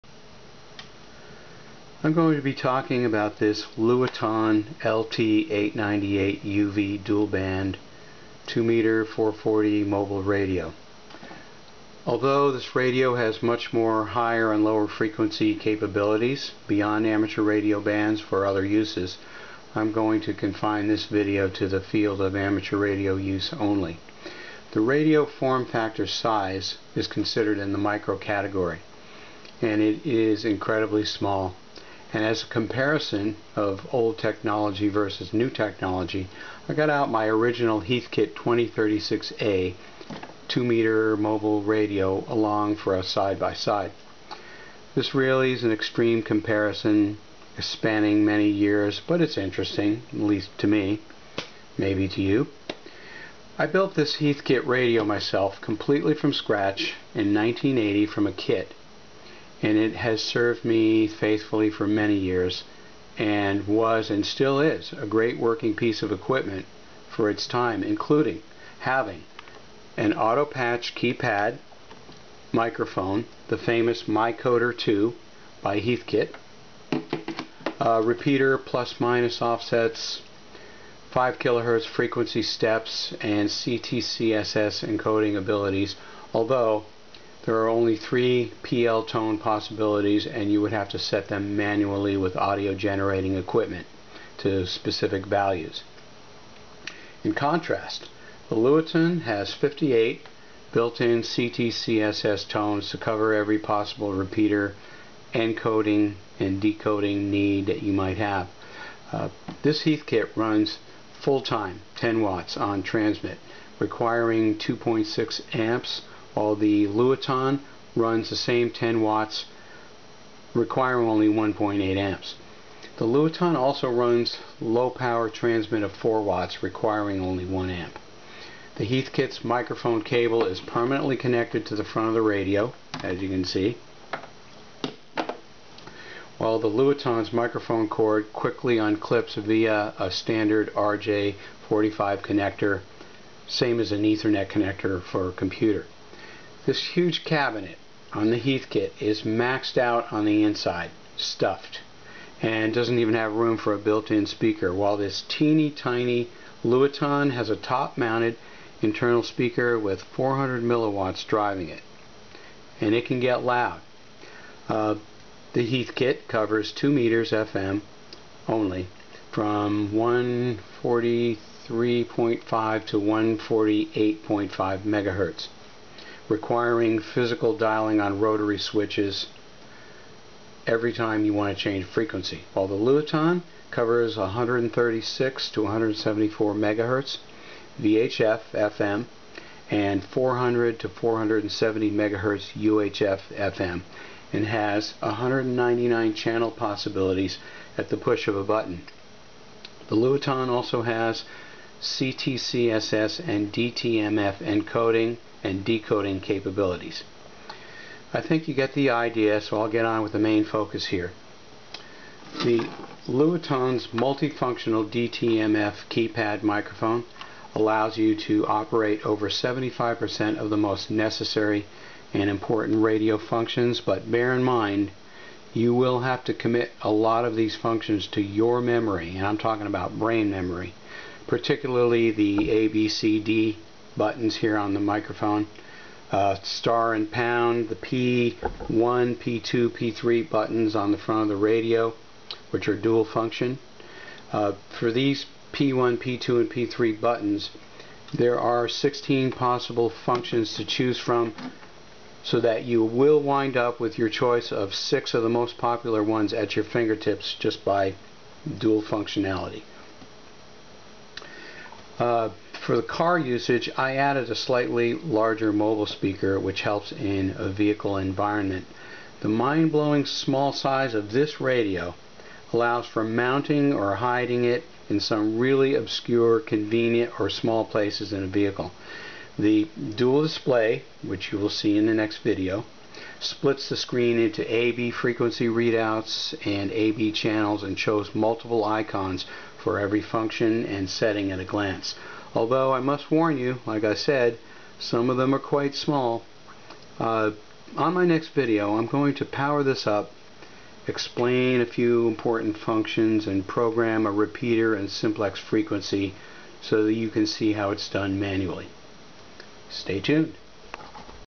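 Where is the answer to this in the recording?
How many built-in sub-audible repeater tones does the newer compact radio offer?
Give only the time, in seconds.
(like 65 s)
99 s.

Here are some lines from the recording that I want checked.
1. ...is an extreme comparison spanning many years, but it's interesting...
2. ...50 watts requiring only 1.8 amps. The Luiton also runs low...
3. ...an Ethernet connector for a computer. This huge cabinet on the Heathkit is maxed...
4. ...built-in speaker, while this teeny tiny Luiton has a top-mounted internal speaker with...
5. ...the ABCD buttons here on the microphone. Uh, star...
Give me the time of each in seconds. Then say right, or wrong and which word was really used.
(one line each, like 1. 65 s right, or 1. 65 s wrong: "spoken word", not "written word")
1. 45 s right
2. 118 s wrong: "10", not "50"
3. 143 s right
4. 153 s right
5. 232 s right.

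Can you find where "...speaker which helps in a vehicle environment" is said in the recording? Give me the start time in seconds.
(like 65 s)
265 s.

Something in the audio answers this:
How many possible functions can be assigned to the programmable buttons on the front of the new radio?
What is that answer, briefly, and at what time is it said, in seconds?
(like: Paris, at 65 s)
16, at 248 s.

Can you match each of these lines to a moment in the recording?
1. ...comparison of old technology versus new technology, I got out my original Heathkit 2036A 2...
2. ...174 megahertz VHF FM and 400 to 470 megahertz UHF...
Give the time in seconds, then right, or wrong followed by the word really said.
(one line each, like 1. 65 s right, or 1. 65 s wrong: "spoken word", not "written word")
1. 32 s right
2. 185 s right.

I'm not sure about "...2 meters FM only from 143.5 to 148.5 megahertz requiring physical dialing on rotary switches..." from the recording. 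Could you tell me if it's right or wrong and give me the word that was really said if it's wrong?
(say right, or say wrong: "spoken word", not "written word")
right.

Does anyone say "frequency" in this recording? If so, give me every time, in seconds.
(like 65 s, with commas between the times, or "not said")
14 s, 81 s, 181 s, 284 s, 305 s.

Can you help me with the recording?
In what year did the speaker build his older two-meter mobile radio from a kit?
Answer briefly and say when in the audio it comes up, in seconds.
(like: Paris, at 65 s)
1980, at 57 s.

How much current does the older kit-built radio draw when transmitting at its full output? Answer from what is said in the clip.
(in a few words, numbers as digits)
2.6 amps.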